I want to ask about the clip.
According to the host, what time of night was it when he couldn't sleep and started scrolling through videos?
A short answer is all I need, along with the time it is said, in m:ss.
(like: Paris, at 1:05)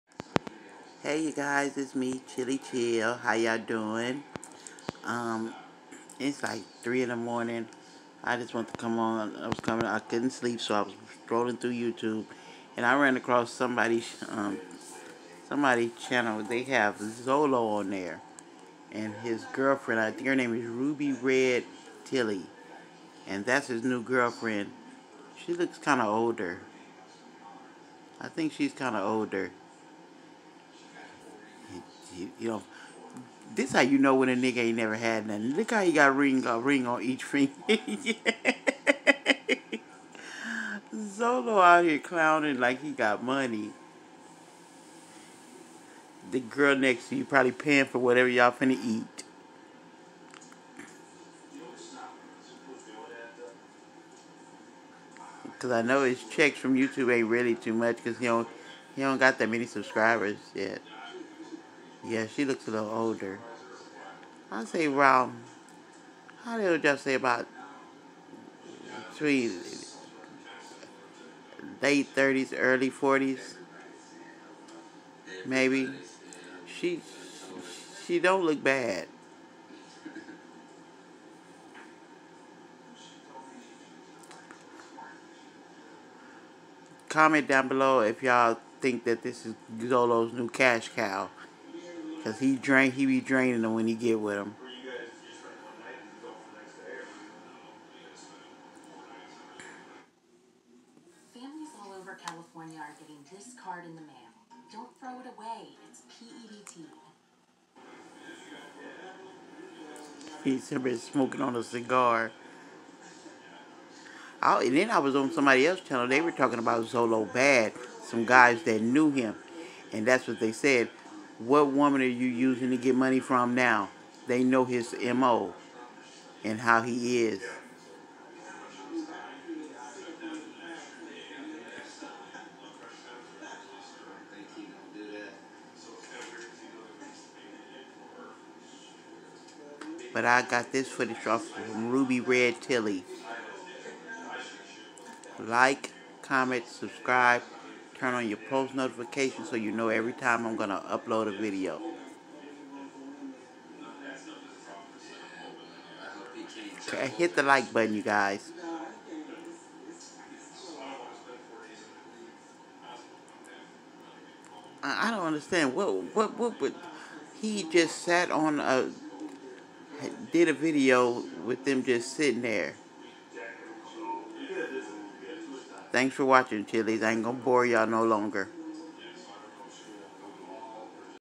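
3 in the morning, at 0:06.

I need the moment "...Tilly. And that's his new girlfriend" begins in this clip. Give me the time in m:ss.
0:22.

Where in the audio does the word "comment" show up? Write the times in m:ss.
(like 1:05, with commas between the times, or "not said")
1:27, 2:26.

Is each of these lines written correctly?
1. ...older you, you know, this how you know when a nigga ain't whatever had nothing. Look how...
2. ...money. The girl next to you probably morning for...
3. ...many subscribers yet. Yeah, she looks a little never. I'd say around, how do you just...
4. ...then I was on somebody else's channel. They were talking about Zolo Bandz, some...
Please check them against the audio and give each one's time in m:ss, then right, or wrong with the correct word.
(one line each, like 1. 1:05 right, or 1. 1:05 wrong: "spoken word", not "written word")
1. 0:29 wrong: "never", not "whatever"
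2. 0:43 wrong: "paying", not "morning"
3. 0:59 wrong: "older", not "never"
4. 1:54 right.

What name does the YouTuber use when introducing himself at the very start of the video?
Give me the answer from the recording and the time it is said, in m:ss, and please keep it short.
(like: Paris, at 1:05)
Chilly Chill, at 0:02.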